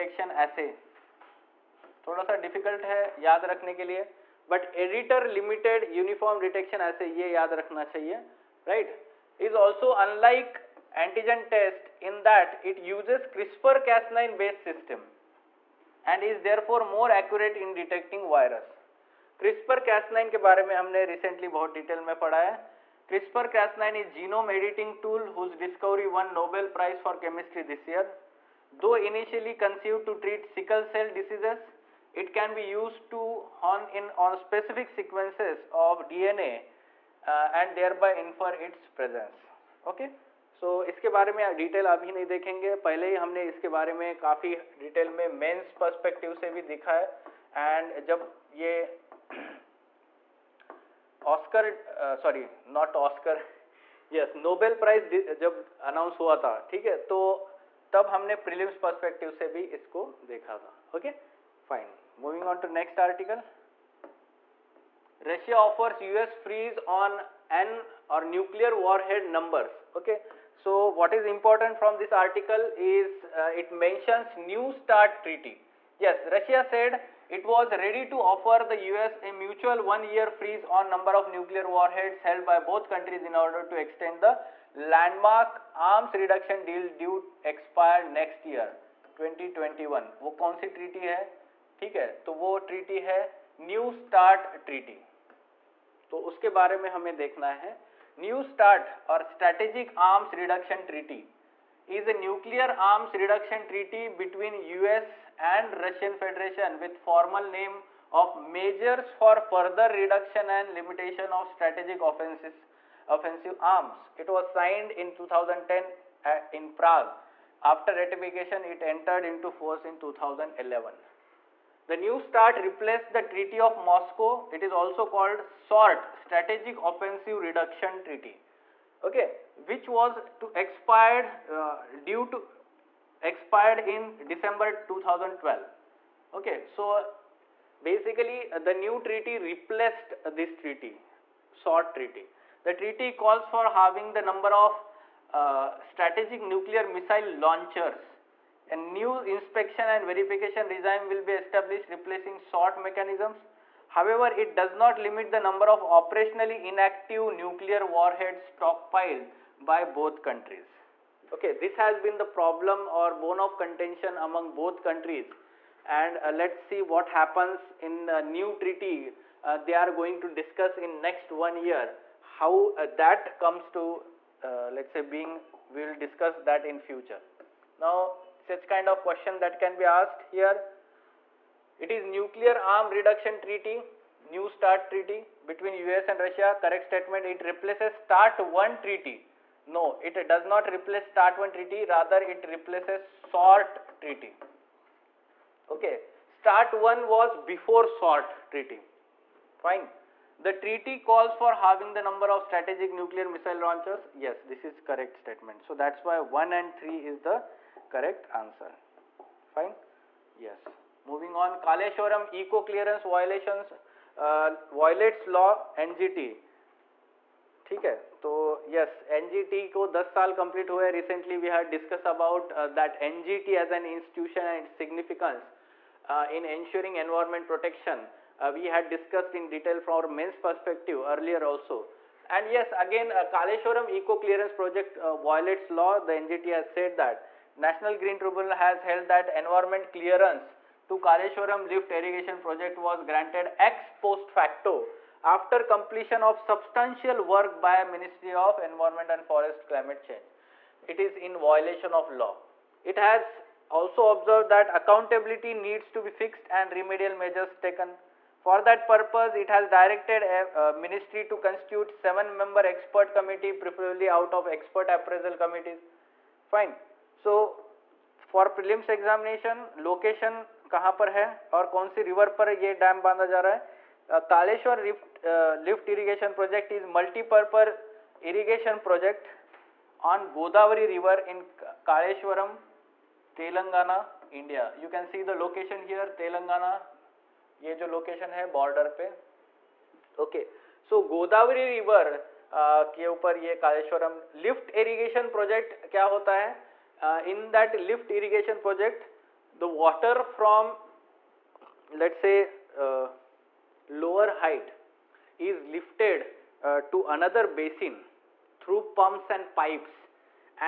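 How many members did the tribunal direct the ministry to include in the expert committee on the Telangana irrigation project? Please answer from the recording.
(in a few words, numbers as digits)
7.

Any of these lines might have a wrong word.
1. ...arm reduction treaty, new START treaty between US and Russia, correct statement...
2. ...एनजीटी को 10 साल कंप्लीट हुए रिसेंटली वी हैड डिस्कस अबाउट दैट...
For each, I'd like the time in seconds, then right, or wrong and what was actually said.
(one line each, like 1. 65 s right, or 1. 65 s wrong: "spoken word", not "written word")
1. 182 s right
2. 219 s right.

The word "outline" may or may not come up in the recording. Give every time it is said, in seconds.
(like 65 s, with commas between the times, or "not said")
not said.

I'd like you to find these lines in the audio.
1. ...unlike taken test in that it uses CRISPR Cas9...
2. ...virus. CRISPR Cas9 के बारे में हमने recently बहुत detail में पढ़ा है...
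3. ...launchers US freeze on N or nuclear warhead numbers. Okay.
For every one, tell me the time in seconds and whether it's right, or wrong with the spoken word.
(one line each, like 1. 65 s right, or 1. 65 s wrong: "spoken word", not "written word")
1. 9 s wrong: "antigen", not "taken"
2. 18 s right
3. 65 s wrong: "offers", not "launchers".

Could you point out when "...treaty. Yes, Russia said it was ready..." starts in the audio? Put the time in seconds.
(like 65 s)
75 s.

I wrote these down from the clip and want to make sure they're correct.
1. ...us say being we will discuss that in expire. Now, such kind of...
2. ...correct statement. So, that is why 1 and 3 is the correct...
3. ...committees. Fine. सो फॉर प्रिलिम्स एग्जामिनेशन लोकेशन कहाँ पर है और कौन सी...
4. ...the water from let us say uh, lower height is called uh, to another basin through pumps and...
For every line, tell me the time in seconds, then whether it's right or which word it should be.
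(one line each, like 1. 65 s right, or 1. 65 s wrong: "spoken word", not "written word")
1. 174 s wrong: "future", not "expire"
2. 204 s right
3. 265 s right
4. 299 s wrong: "lifted", not "called".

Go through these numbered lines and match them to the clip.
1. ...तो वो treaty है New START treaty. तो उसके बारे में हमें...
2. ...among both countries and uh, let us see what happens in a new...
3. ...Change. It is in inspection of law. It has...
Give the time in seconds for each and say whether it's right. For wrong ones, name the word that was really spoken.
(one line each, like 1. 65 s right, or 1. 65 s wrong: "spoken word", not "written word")
1. 92 s right
2. 164 s right
3. 250 s wrong: "violation", not "inspection".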